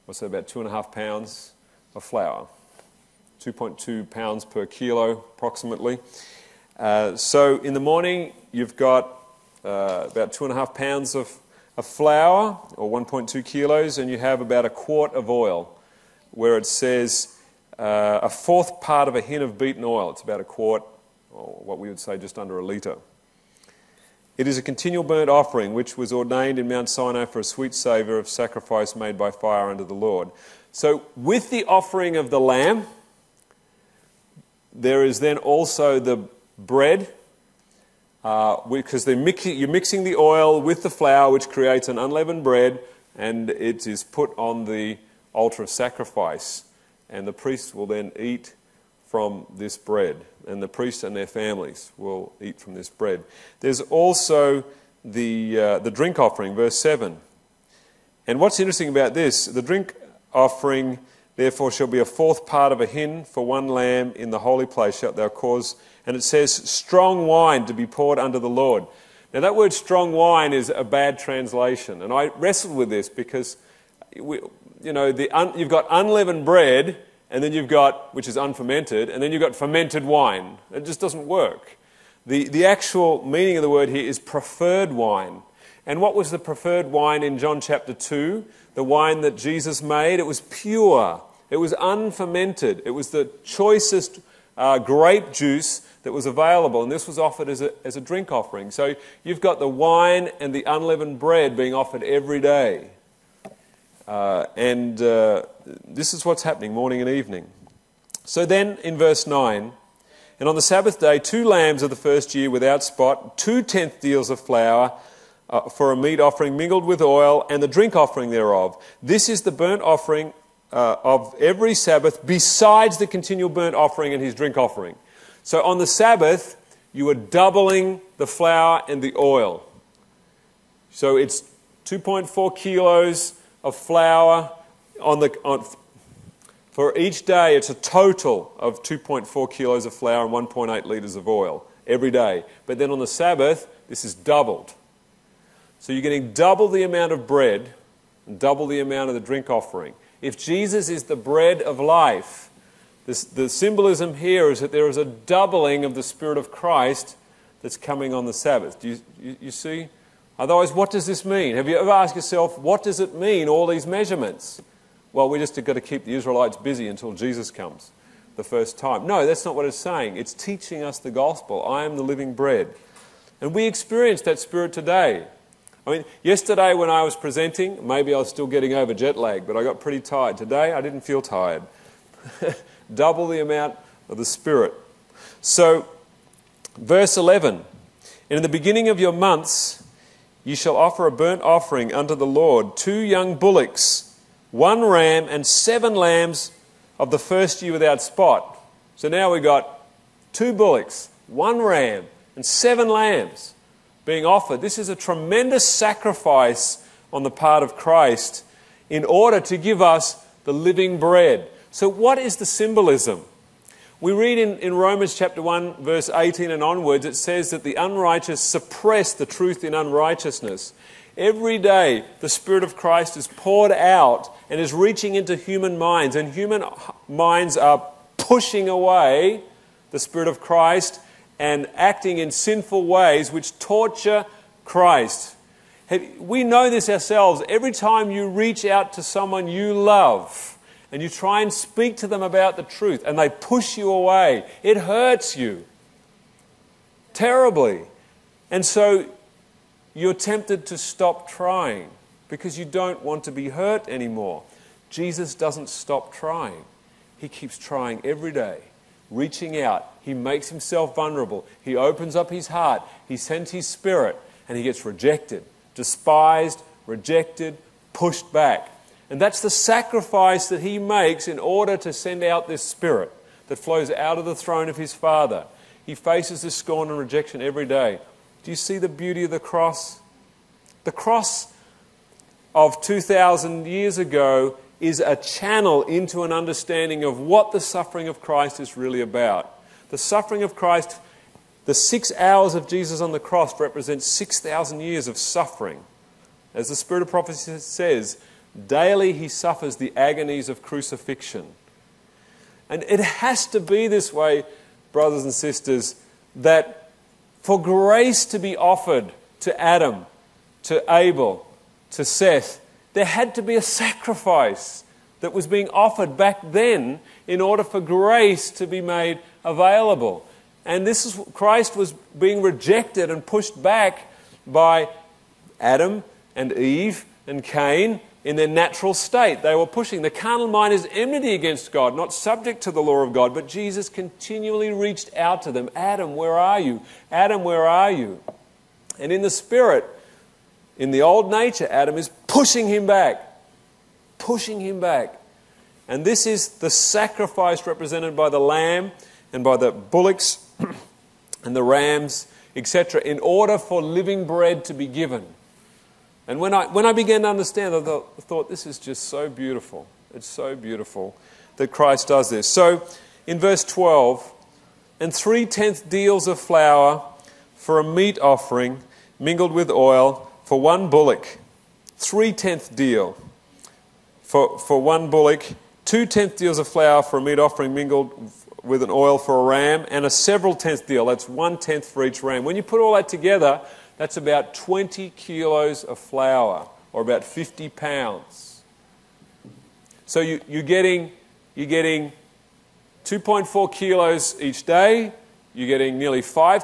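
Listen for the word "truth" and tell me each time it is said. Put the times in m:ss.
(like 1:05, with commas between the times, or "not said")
3:39, 4:02.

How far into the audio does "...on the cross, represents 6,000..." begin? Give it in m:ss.
4:53.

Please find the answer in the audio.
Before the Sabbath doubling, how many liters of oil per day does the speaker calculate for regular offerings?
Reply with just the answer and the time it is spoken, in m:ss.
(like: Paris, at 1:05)
1.8 liters, at 2:20.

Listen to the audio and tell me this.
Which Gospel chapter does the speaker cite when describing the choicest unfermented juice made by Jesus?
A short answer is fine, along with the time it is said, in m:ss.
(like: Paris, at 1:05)
John chapter 2, at 1:27.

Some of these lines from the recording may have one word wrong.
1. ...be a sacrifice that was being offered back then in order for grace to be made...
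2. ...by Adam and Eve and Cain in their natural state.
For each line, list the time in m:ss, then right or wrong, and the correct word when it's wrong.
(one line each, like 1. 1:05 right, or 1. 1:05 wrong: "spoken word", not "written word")
1. 5:13 right
2. 5:24 right.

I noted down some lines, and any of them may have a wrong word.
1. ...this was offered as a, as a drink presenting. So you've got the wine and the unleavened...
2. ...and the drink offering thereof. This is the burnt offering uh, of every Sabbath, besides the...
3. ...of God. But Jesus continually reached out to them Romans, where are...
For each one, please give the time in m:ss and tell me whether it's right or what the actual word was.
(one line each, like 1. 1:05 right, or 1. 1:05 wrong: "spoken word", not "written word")
1. 1:36 wrong: "offering", not "presenting"
2. 1:57 right
3. 5:33 wrong: "Adam", not "Romans".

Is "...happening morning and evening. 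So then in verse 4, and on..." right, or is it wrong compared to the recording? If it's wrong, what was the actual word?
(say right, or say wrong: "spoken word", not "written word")
wrong: "9", not "4".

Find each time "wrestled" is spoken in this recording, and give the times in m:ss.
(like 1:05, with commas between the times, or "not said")
1:12.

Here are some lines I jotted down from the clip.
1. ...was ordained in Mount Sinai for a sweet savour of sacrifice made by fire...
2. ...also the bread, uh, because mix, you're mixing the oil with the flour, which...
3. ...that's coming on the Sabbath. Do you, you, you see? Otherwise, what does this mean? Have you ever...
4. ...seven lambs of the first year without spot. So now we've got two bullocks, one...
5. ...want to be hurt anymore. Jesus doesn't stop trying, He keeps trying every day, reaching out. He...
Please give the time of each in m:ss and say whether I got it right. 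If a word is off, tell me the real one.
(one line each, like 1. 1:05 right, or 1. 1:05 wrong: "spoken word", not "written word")
1. 0:25 right
2. 0:35 right
3. 2:37 right
4. 3:15 right
5. 4:13 right.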